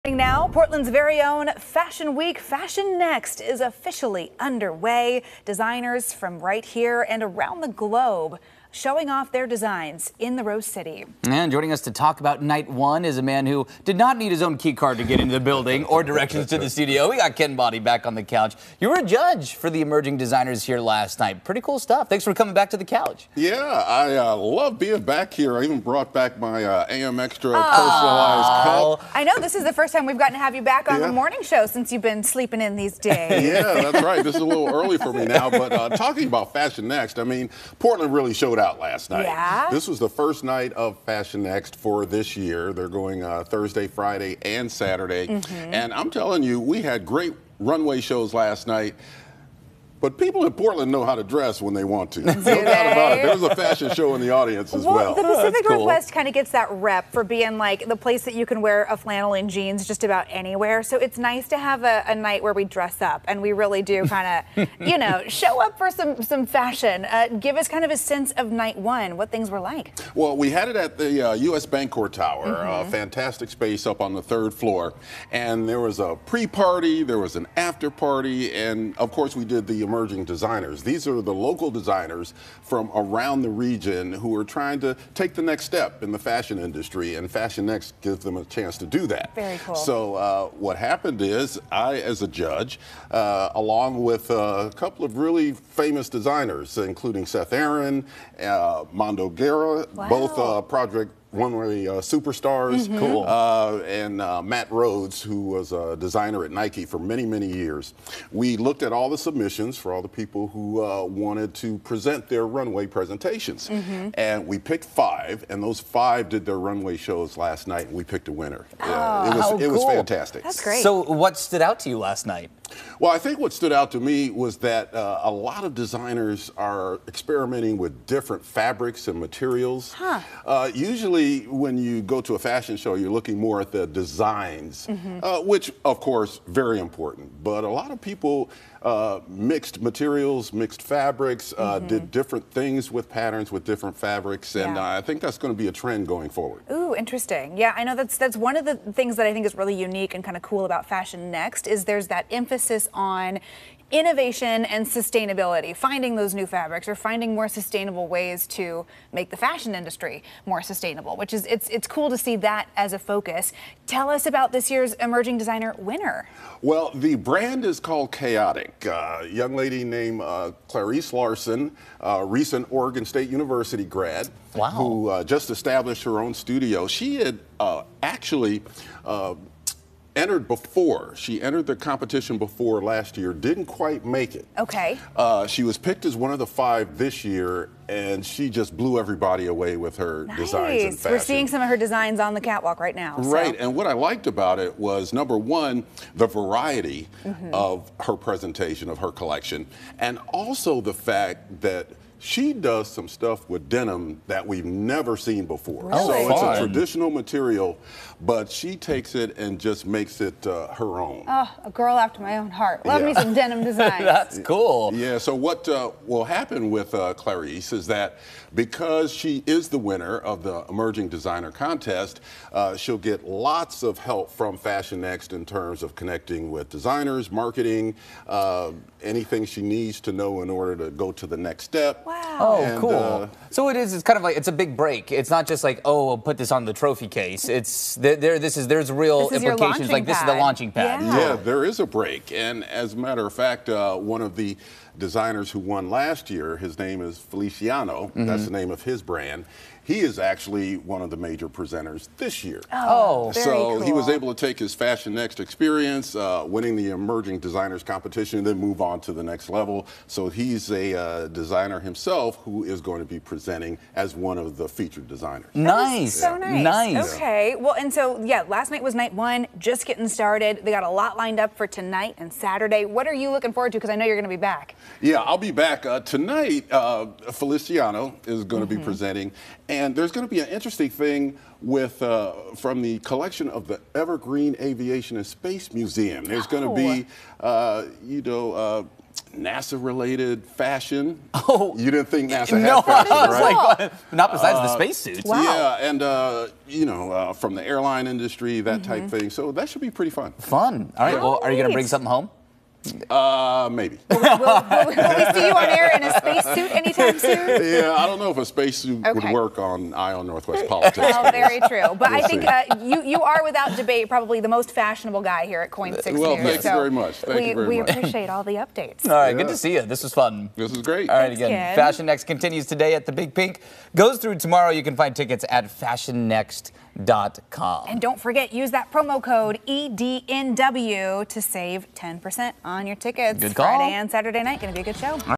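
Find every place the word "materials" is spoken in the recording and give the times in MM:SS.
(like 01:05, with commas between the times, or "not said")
02:09, 02:19, 03:27.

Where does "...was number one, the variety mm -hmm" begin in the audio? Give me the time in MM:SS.
03:14.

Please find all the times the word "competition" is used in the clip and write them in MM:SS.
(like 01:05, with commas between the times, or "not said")
03:01, 04:17.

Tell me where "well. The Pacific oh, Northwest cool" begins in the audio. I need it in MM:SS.
00:54.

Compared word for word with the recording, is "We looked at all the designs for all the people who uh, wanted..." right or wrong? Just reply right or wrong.
wrong.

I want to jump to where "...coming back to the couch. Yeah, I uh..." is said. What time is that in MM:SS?
00:22.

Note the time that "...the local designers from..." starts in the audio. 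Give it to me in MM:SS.
01:21.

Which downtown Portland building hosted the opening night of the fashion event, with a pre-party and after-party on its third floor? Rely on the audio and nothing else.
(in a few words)
U.S. Bancorp Tower.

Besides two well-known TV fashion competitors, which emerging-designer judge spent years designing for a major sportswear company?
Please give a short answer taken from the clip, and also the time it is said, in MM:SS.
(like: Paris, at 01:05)
Matt Rhodes, at 01:44.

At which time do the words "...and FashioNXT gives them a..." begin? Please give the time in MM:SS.
01:27.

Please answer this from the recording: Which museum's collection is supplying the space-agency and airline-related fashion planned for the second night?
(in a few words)
Evergreen Aviation and Space Museum.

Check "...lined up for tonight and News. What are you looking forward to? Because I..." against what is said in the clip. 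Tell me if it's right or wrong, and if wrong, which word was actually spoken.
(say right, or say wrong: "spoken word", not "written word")
wrong: "Saturday", not "News".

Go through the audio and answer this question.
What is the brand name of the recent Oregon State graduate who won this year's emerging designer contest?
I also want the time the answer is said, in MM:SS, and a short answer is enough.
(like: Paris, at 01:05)
Chaotic, at 02:48.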